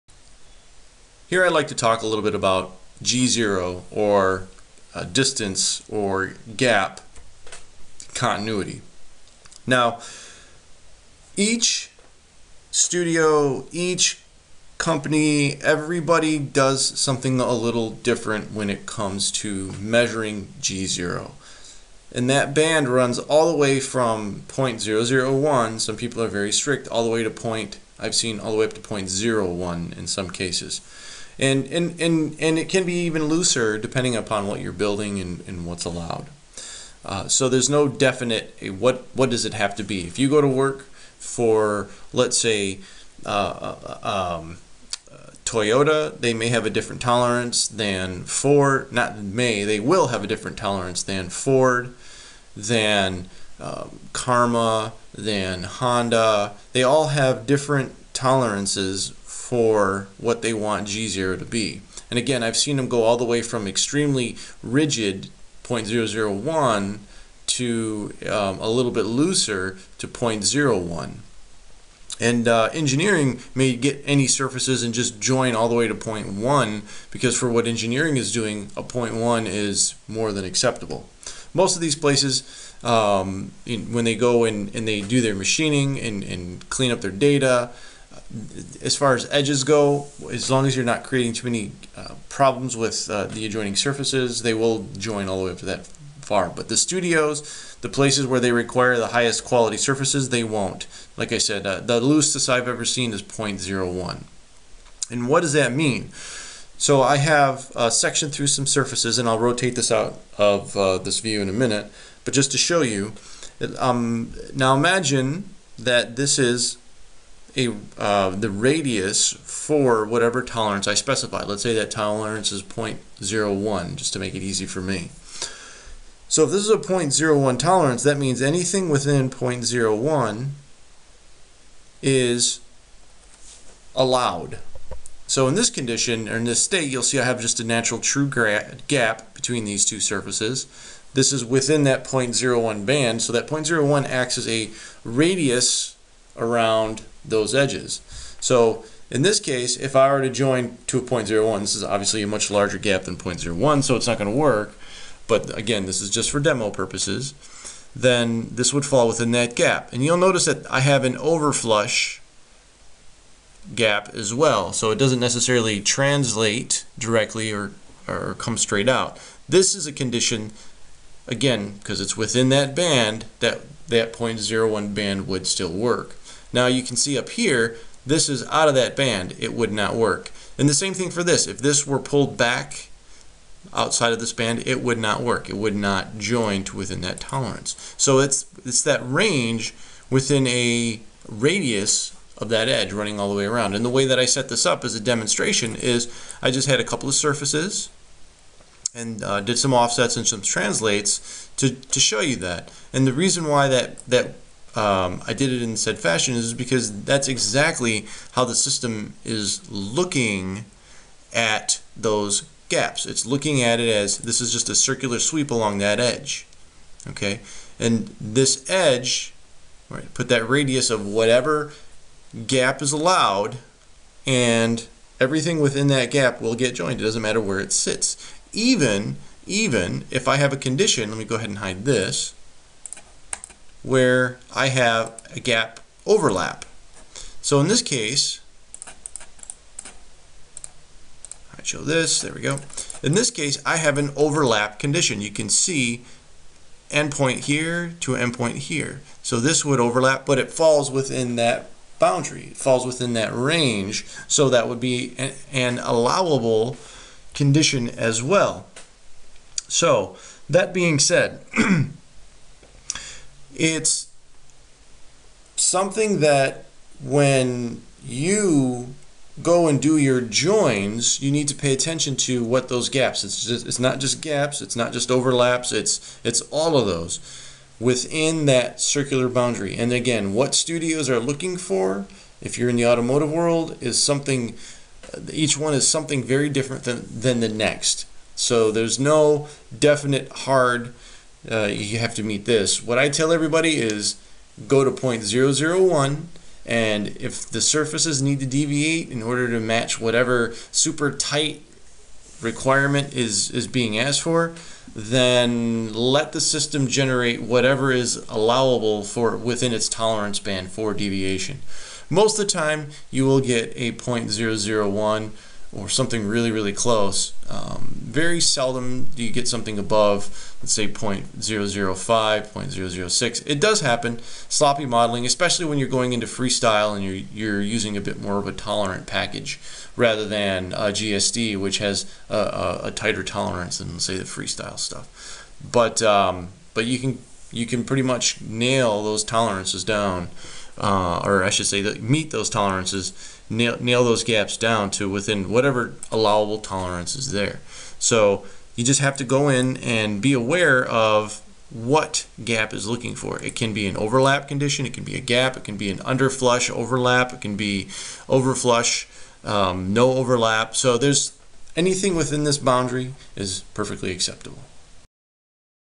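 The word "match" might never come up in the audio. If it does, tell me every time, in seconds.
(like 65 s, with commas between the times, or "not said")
299 s.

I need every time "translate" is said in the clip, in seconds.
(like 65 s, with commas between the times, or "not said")
165 s, 200 s.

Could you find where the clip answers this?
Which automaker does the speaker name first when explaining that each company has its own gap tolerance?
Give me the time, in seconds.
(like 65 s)
45 s.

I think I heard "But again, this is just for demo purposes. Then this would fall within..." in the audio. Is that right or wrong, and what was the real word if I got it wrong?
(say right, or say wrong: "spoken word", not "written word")
right.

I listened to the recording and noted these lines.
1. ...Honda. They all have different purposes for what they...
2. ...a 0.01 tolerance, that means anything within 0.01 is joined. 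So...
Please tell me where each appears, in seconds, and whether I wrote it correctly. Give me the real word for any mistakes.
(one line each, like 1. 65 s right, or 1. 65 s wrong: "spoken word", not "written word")
1. 55 s wrong: "tolerances", not "purposes"
2. 126 s wrong: "allowed", not "joined".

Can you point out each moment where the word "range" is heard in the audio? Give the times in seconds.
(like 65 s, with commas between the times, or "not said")
189 s, 253 s.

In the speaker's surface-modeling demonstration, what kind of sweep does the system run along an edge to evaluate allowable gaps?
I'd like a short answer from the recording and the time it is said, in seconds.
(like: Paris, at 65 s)
circular sweep, at 214 s.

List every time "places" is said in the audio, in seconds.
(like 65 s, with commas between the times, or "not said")
81 s, 97 s.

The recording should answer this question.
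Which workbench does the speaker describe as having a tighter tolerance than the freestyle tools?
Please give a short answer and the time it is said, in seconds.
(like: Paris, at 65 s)
GSD, at 330 s.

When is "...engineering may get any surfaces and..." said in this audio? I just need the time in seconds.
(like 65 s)
72 s.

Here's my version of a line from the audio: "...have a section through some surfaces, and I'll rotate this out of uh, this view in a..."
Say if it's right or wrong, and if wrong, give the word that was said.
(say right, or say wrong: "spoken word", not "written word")
right.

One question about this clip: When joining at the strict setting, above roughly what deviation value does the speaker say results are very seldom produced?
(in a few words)
0.005.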